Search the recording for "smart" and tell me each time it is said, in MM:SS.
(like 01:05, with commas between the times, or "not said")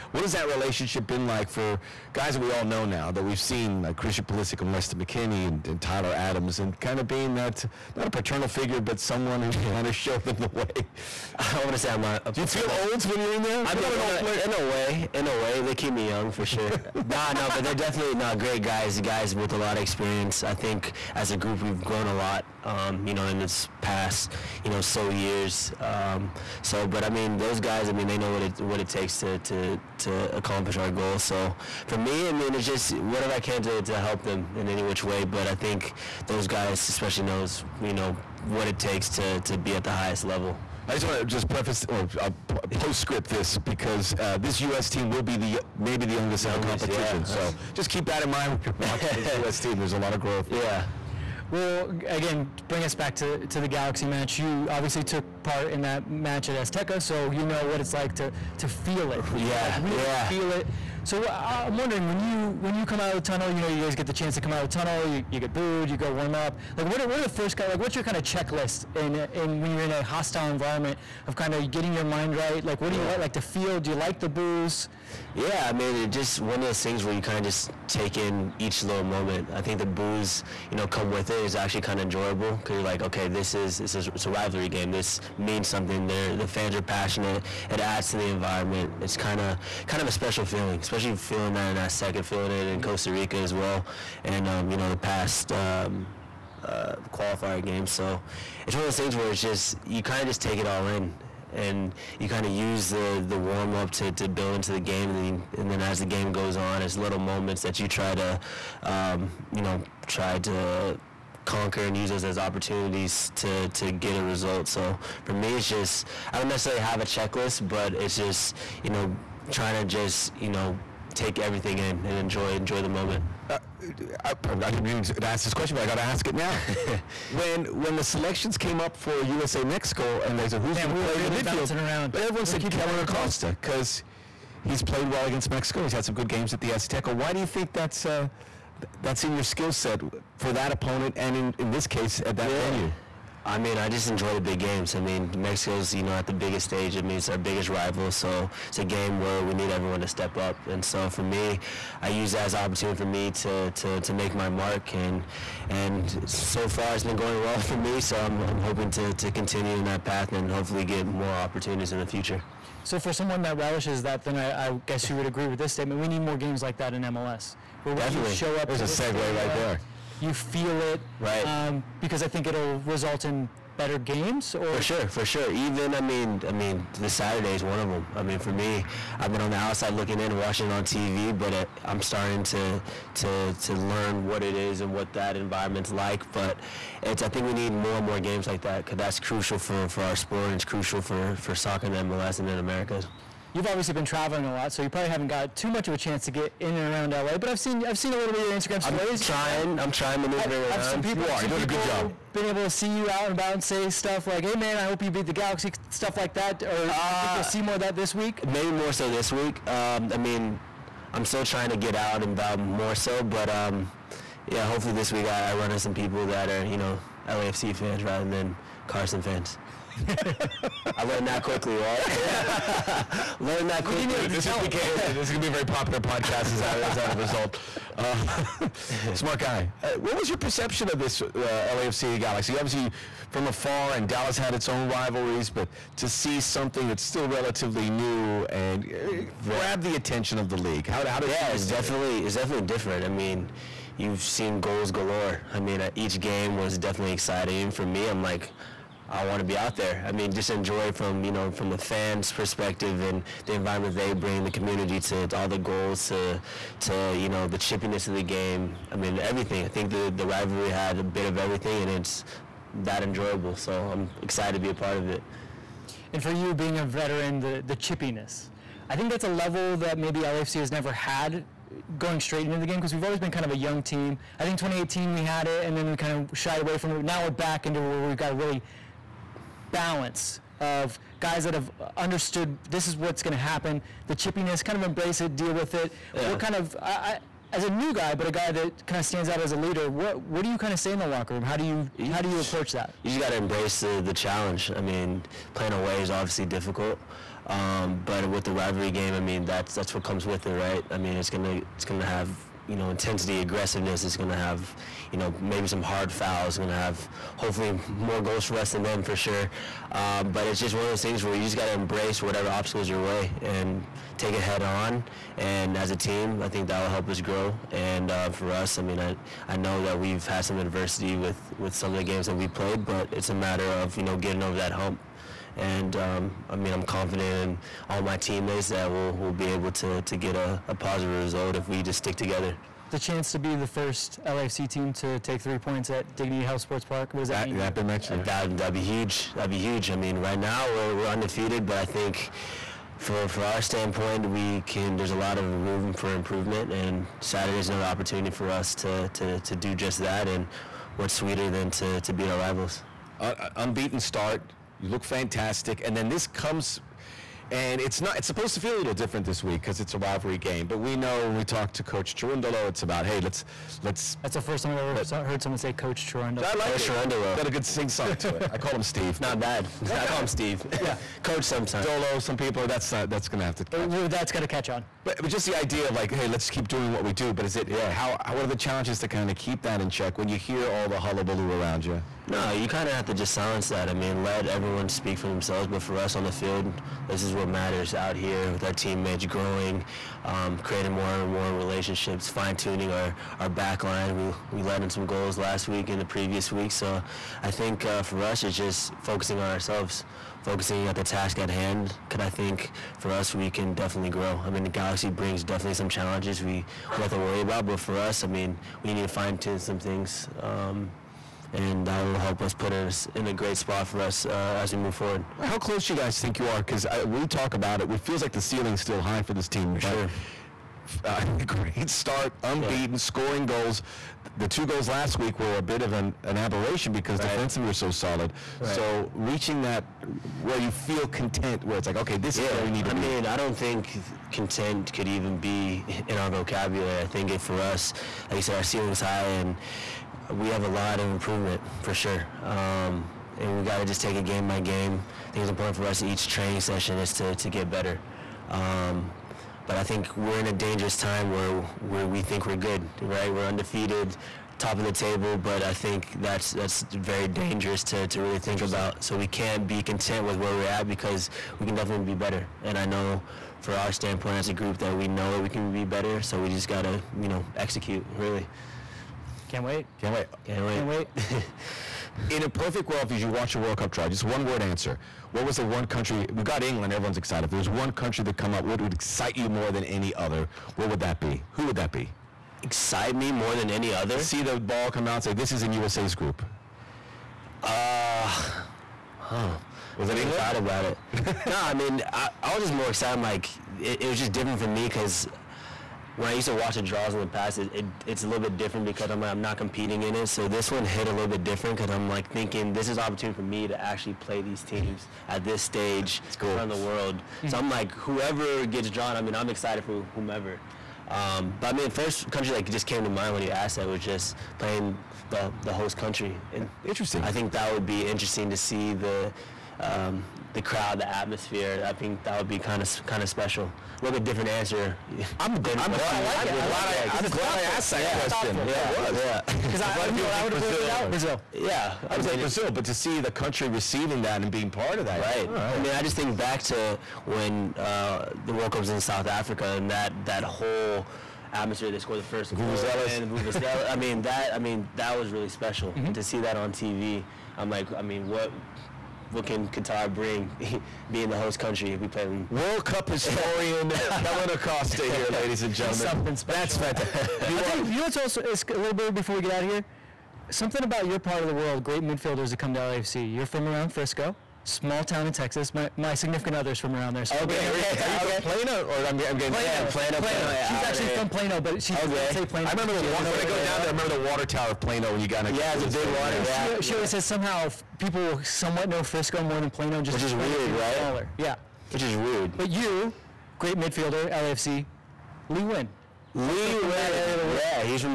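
03:49.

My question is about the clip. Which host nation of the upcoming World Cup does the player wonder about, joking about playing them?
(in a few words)
Qatar.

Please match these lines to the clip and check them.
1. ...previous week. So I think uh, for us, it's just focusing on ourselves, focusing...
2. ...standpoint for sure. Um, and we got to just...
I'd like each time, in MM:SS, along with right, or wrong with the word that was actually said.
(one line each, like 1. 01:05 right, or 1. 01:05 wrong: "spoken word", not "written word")
1. 06:36 right
2. 07:21 wrong: "improvement", not "standpoint".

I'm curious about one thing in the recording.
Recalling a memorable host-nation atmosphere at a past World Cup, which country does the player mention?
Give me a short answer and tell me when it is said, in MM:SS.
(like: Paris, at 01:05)
South Africa, at 08:59.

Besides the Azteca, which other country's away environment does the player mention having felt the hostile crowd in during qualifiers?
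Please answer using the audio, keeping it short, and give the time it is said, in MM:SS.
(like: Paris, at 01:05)
Costa Rica, at 01:32.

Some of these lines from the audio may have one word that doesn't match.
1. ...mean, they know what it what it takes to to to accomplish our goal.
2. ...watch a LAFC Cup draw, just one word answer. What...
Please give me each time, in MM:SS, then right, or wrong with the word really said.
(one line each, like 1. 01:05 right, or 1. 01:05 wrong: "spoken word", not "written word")
1. 00:27 right
2. 07:53 wrong: "World", not "LAFC".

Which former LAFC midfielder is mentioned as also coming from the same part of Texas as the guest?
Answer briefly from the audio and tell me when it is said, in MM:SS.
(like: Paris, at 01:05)
Lee Nguyen, at 09:45.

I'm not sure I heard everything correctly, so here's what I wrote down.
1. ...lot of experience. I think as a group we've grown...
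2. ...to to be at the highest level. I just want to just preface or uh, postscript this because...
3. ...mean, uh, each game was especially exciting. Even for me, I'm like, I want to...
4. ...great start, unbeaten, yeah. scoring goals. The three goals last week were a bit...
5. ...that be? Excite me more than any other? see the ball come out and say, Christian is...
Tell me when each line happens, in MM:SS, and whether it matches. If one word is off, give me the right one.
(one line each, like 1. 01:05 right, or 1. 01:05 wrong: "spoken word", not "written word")
1. 00:19 right
2. 00:39 right
3. 04:05 wrong: "definitely", not "especially"
4. 07:01 wrong: "two", not "three"
5. 08:01 wrong: "This", not "Christian".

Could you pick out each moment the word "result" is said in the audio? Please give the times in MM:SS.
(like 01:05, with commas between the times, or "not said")
01:54, 02:52, 03:47, 05:31.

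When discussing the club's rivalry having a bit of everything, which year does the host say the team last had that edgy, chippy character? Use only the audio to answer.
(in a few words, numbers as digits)
2018.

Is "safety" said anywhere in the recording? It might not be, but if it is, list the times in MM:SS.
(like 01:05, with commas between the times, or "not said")
not said.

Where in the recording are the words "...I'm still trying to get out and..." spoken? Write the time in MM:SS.
03:31.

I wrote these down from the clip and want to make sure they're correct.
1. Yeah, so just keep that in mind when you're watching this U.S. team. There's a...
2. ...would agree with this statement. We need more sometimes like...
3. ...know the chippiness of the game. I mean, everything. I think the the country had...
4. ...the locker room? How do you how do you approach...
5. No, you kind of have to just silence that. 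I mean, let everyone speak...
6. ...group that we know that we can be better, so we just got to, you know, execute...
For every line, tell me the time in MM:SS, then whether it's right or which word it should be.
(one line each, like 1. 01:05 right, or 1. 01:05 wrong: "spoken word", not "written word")
1. 00:47 right
2. 02:45 wrong: "games", not "sometimes"
3. 04:17 wrong: "rivalry", not "country"
4. 04:50 right
5. 06:22 right
6. 07:44 right.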